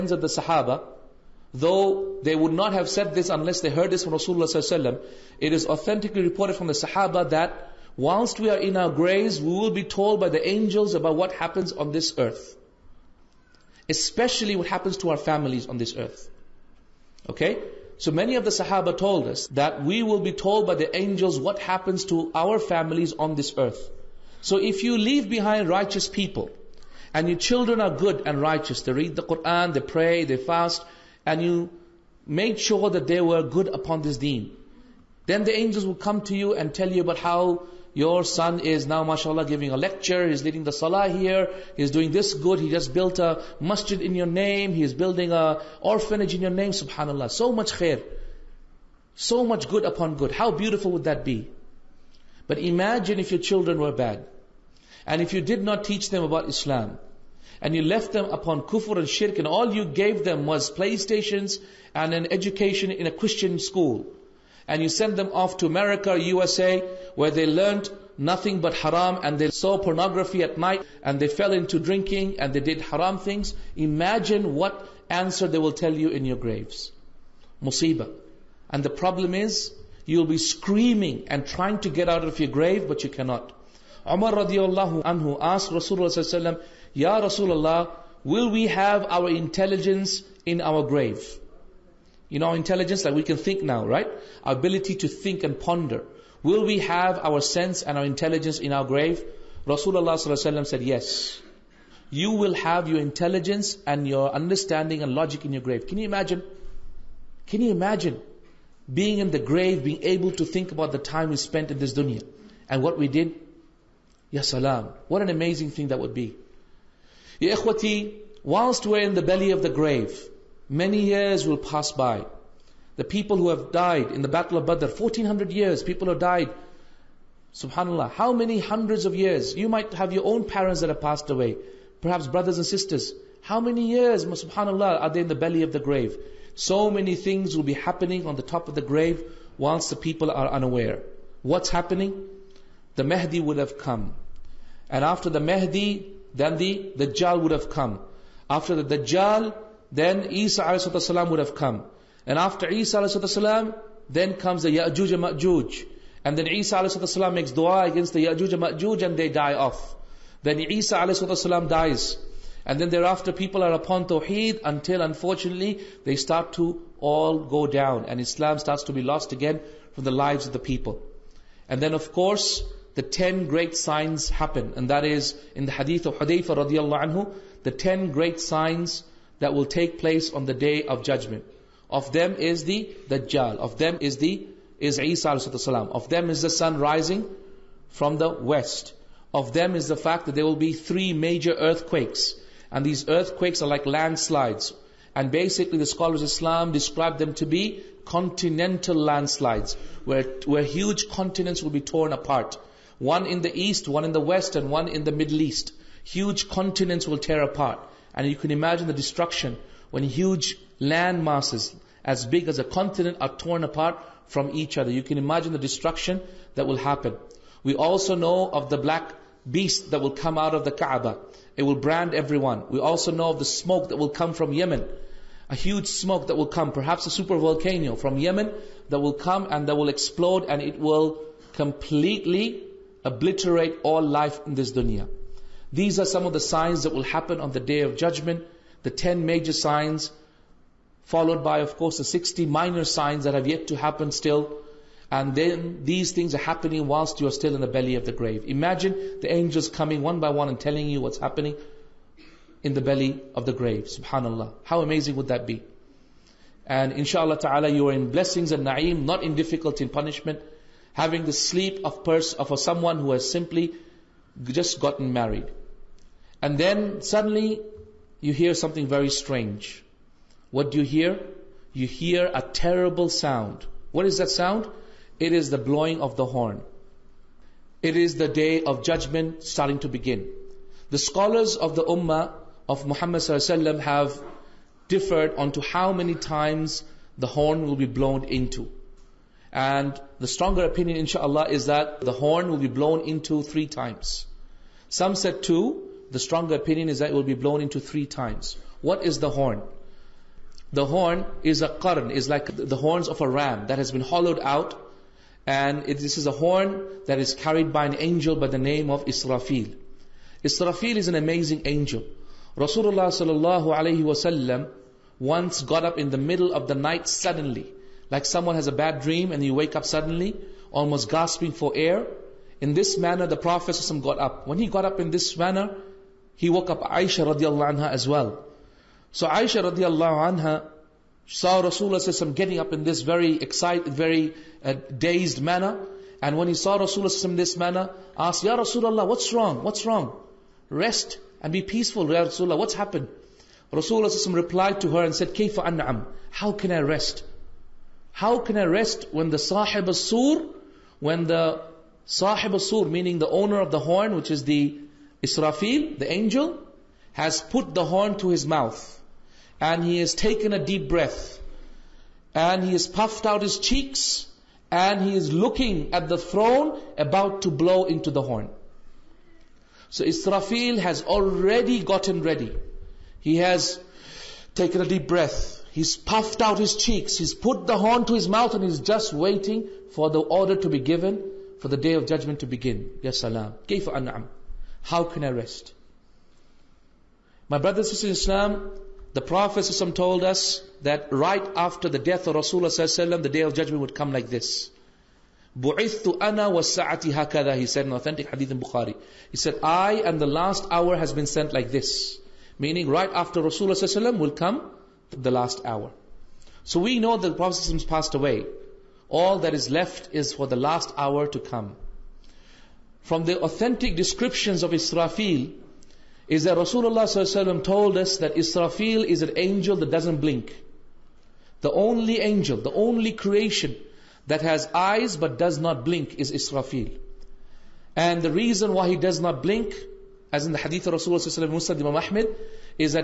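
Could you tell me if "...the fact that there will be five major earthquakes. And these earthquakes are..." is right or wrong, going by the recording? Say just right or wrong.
wrong.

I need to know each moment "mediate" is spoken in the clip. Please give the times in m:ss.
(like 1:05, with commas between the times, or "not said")
not said.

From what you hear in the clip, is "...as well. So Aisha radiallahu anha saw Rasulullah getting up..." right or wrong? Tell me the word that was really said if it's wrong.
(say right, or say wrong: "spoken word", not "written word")
right.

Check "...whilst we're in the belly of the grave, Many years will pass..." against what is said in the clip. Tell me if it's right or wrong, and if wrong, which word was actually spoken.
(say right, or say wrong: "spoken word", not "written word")
right.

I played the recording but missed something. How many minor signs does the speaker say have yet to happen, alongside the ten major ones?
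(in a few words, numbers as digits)
60.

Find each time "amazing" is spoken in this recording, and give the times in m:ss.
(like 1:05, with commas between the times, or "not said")
1:55, 4:14, 5:11.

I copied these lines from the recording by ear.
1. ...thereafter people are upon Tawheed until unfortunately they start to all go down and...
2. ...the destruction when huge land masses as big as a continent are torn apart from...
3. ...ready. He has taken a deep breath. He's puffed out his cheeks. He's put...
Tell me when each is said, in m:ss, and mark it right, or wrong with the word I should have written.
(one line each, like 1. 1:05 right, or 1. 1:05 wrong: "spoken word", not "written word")
1. 2:42 right
2. 3:28 right
3. 6:12 right.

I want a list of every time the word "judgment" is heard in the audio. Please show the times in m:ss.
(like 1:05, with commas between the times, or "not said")
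3:01, 3:57, 4:38, 6:22, 6:33.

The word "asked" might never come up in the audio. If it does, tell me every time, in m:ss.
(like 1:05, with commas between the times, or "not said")
1:25, 5:38.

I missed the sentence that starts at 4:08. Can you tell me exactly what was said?
Imagine the angels coming one by one and telling you what's happening in the belly of the grave.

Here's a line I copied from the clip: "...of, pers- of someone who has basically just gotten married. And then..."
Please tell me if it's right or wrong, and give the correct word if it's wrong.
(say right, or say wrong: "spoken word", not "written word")
wrong: "simply", not "basically".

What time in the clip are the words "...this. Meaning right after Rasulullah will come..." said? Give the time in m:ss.
6:41.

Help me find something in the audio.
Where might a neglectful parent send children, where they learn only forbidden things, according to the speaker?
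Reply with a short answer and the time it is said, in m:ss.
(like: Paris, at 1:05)
America, at 1:05.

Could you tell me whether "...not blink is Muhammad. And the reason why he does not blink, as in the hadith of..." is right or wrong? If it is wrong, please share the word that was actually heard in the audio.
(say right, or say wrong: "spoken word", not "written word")
wrong: "Israfil", not "Muhammad".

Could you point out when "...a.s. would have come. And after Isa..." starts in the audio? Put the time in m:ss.
2:30.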